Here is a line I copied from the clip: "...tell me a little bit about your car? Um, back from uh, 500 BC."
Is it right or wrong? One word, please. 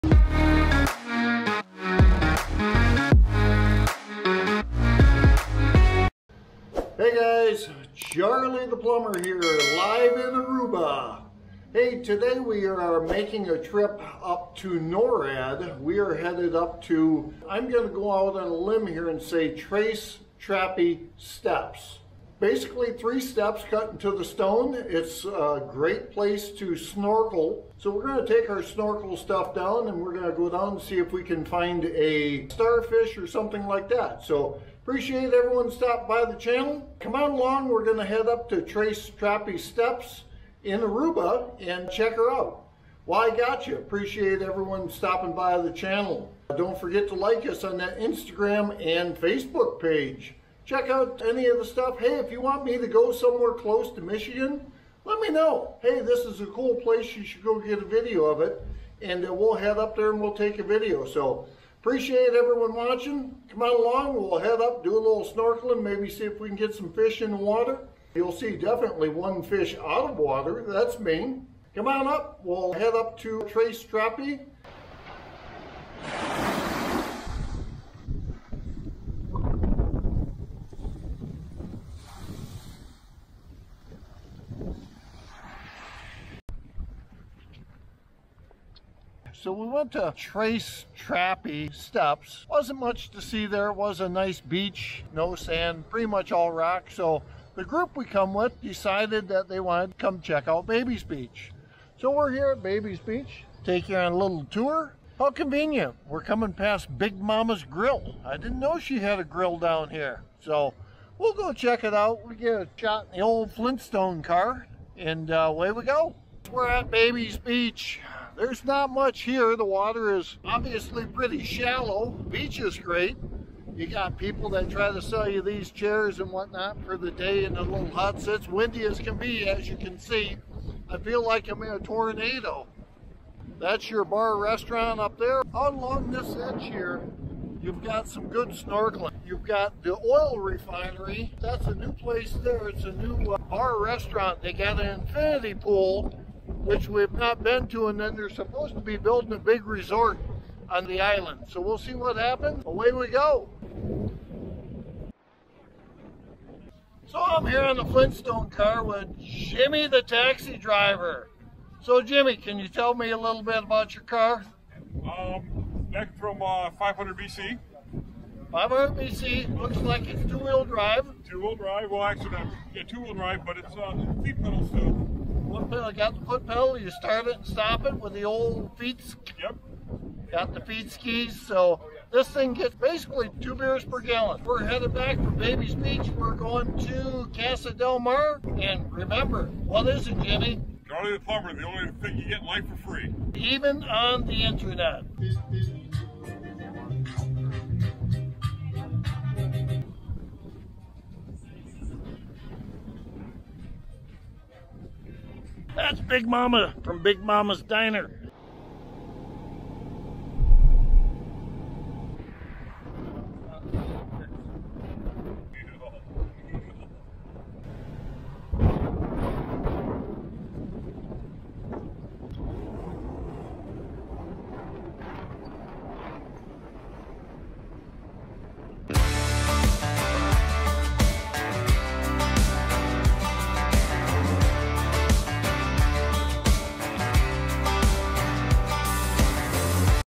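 right.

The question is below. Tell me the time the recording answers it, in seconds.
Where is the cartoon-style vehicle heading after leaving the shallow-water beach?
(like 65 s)
187 s.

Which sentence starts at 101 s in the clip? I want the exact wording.
So we're here at Babies Beach, take you on a little tour.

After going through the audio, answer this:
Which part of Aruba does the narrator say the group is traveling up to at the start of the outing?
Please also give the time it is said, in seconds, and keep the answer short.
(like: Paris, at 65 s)
Noord, at 14 s.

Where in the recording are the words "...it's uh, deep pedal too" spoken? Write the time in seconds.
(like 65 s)
173 s.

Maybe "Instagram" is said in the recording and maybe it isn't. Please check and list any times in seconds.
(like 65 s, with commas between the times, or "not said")
47 s.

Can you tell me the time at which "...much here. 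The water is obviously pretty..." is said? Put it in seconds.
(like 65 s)
118 s.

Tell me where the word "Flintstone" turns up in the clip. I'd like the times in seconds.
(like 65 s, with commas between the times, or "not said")
113 s, 157 s.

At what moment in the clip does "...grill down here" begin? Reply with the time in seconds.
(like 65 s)
109 s.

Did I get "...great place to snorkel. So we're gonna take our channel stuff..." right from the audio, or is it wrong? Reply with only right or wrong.
wrong.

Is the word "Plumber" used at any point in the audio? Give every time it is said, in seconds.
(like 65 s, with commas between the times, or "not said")
8 s, 191 s.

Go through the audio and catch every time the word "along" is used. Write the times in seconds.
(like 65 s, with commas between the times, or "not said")
37 s, 63 s, 135 s.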